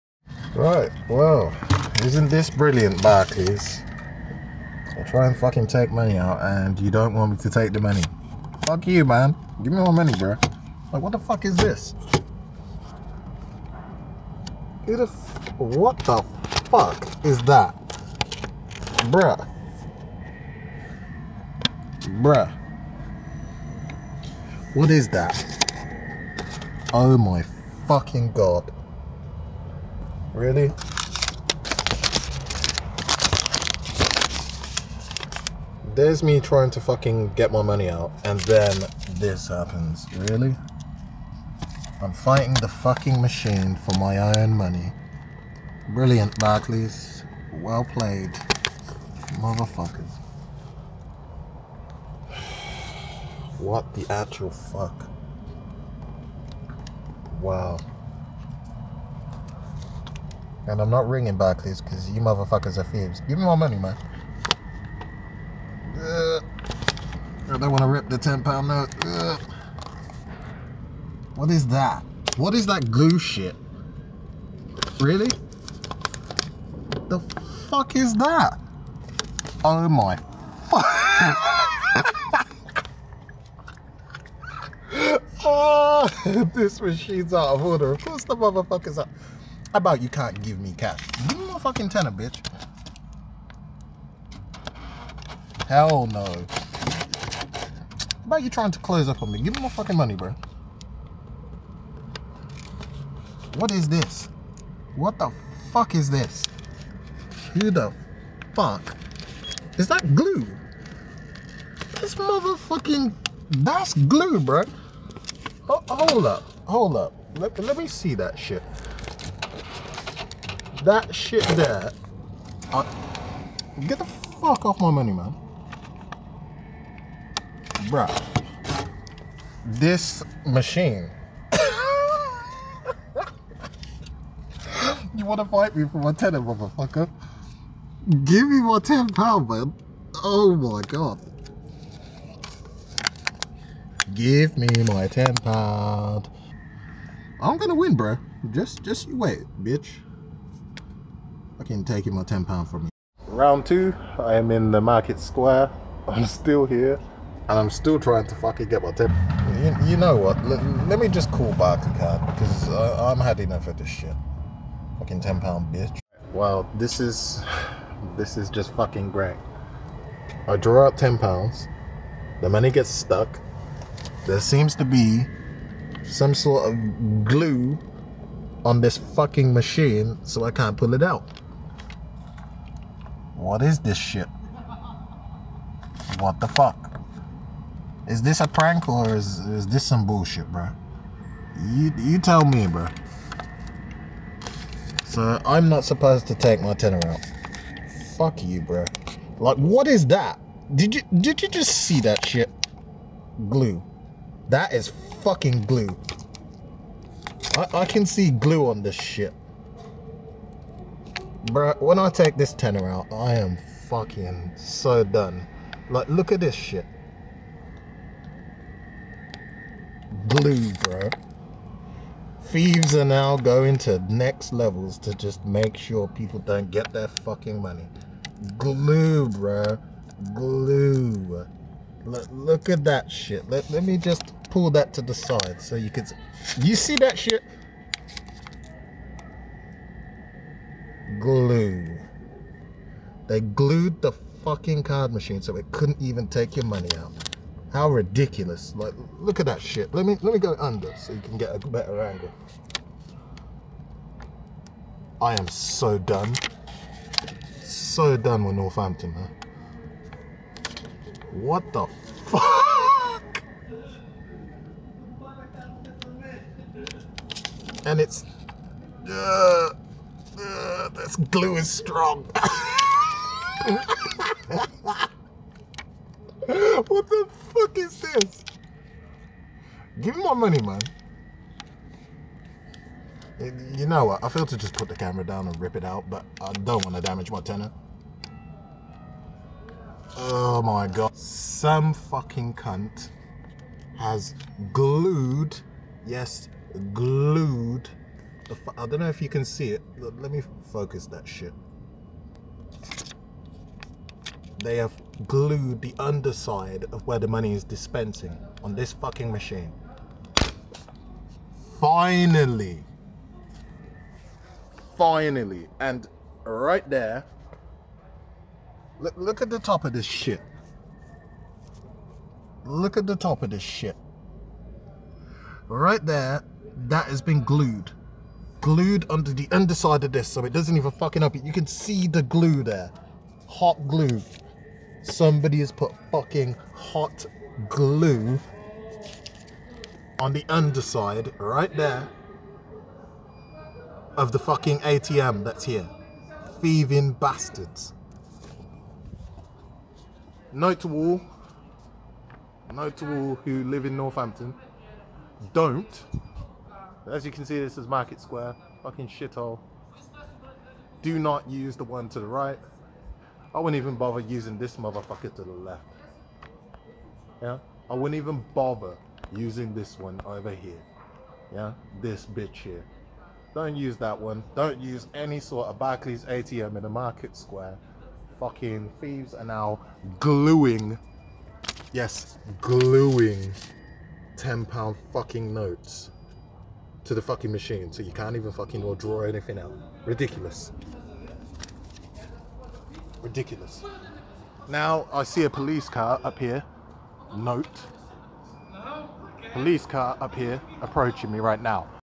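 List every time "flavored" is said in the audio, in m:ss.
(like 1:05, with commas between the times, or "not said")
not said.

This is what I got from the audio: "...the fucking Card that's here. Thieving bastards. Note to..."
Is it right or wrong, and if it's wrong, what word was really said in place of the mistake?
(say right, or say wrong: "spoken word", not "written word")
wrong: "ATM", not "Card".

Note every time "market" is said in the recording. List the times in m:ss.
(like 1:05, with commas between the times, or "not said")
2:34, 5:57, 6:16.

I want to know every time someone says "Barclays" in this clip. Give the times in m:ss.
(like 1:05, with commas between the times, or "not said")
0:03, 0:46, 1:01, 6:15.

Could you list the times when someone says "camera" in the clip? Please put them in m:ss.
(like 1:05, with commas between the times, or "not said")
4:44.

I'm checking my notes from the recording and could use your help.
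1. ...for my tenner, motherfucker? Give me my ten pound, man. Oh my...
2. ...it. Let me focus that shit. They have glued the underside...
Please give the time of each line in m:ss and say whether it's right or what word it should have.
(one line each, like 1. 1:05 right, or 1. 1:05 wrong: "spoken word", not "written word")
1. 2:15 right
2. 4:59 right.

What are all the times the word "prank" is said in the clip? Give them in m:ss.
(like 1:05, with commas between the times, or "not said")
3:08.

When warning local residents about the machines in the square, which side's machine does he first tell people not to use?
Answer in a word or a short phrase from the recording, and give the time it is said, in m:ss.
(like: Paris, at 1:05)
The one to the right, at 6:01.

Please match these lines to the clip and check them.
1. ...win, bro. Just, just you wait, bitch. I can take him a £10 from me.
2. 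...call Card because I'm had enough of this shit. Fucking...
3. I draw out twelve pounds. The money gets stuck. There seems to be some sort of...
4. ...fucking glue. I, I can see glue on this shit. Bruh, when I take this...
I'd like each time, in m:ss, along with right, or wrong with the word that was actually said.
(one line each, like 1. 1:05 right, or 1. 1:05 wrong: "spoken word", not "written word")
1. 2:27 right
2. 2:41 right
3. 2:50 wrong: "ten", not "twelve"
4. 3:25 right.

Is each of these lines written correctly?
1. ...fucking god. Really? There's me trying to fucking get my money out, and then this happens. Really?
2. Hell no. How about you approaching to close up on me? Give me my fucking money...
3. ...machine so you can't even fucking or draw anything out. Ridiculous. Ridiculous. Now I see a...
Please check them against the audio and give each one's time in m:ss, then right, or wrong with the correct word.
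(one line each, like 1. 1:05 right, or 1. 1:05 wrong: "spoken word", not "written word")
1. 0:27 right
2. 1:35 wrong: "trying", not "approaching"
3. 6:27 right.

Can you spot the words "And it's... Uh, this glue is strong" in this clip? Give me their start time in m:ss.
4:27.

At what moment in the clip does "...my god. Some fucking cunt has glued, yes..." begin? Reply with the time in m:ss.
4:50.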